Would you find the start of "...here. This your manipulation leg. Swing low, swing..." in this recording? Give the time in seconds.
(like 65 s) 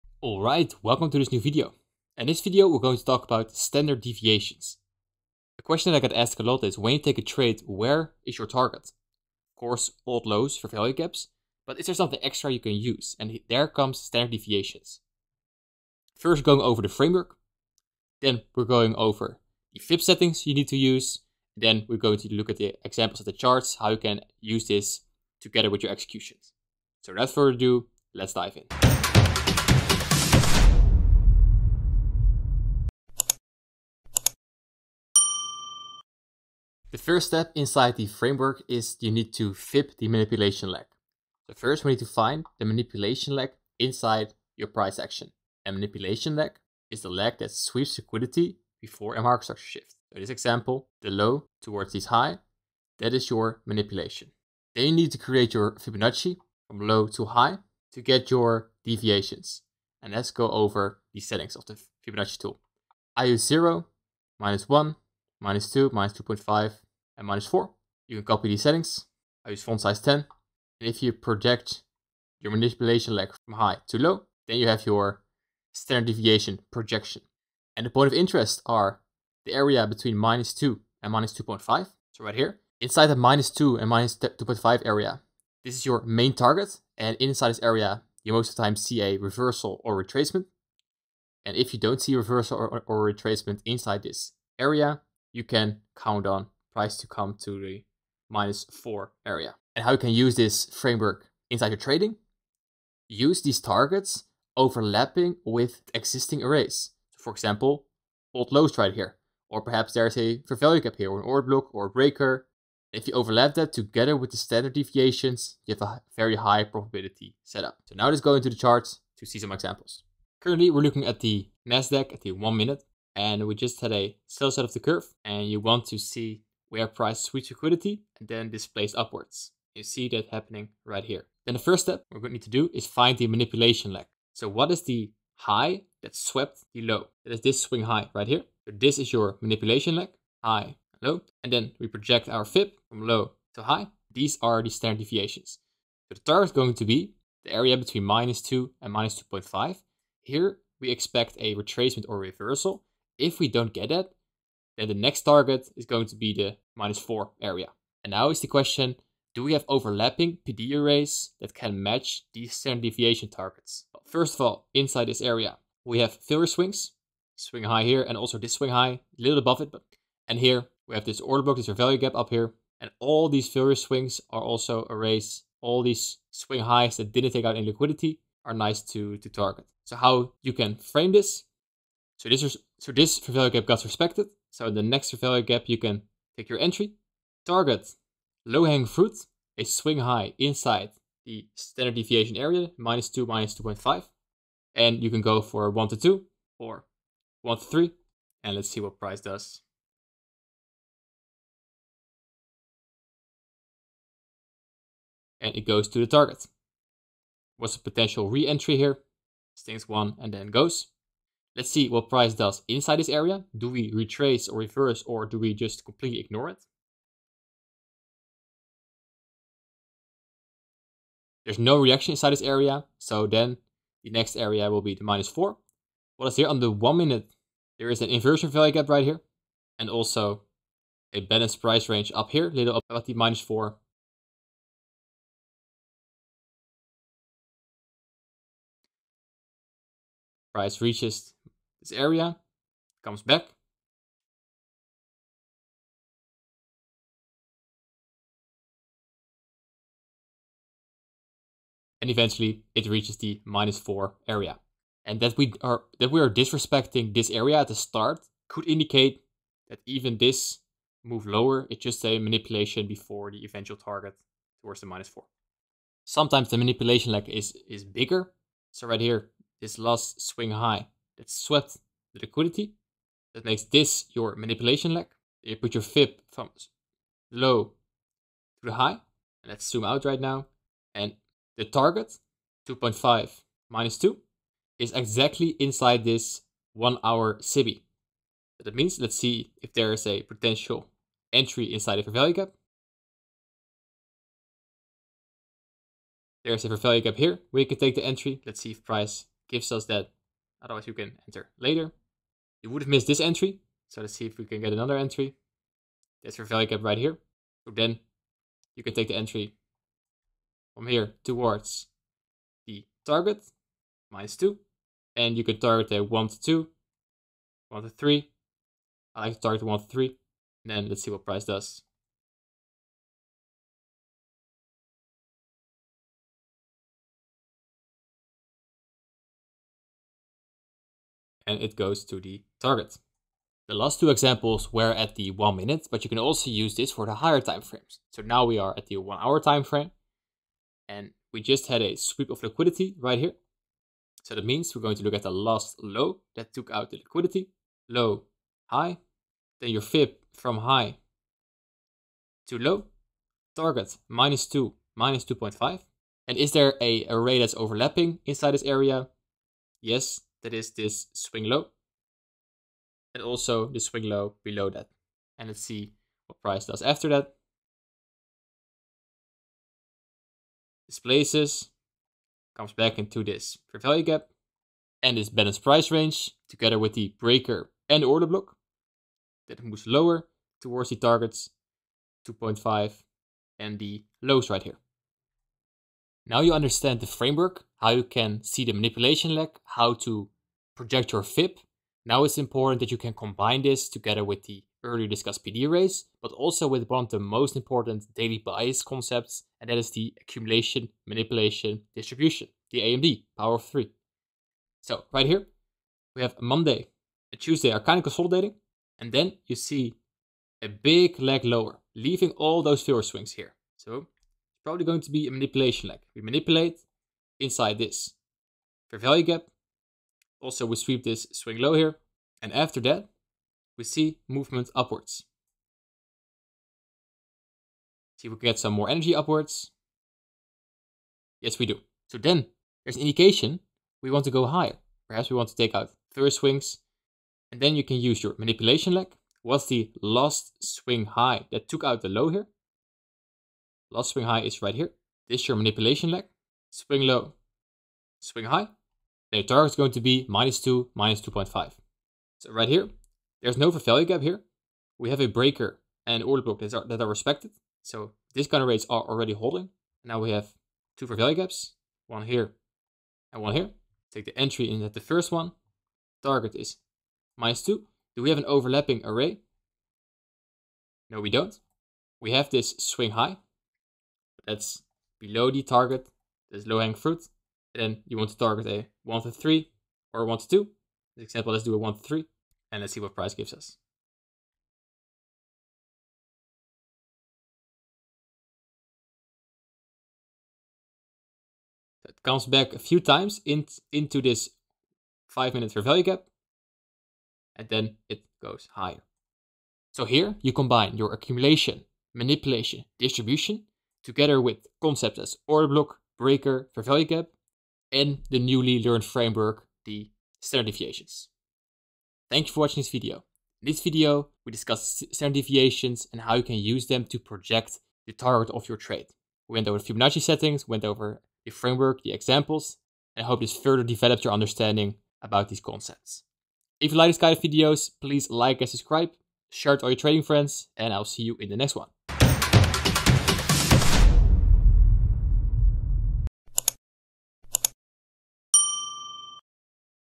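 444 s.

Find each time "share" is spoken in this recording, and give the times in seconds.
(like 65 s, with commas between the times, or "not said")
529 s.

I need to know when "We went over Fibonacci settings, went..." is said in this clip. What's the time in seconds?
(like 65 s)
519 s.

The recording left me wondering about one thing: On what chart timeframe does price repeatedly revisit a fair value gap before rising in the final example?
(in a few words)
5 minute.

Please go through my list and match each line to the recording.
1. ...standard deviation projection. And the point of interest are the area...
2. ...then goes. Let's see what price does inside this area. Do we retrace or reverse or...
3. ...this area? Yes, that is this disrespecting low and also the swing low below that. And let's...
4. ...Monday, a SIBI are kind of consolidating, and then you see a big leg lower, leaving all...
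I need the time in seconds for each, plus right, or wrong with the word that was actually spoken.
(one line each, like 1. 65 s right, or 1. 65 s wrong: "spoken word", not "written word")
1. 75 s right
2. 210 s right
3. 358 s wrong: "swing", not "disrespecting"
4. 406 s wrong: "Tuesday", not "SIBI".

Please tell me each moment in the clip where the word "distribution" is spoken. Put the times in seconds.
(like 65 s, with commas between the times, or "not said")
401 s, 502 s.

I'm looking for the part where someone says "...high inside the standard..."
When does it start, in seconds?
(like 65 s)
189 s.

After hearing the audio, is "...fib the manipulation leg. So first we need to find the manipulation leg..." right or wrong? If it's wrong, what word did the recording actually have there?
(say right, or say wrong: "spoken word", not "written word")
right.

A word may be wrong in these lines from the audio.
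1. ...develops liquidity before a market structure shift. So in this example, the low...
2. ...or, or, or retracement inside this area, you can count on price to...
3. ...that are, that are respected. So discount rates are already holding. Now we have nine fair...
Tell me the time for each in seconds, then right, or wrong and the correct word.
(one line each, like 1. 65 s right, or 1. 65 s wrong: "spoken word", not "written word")
1. 47 s wrong: "sweeps", not "develops"
2. 92 s right
3. 456 s wrong: "two", not "nine".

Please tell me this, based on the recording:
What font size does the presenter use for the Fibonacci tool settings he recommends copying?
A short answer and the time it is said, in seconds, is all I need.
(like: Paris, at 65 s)
10, at 69 s.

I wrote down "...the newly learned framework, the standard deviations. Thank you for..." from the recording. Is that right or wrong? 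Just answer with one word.
right.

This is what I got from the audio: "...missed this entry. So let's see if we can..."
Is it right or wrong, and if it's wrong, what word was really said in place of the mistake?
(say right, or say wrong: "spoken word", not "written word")
right.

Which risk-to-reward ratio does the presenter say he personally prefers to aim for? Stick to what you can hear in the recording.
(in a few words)
1 to 3.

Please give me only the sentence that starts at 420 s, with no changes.
Also, we sweep this swing low here.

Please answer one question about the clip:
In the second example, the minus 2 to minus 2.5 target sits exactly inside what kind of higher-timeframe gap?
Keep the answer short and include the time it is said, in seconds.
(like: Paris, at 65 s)
One hour SIBI, at 286 s.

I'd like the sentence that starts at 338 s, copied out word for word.
So now we are at the one hour time frame and we just had a sweep of liquidity right here.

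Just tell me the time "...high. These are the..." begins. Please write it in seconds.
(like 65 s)
143 s.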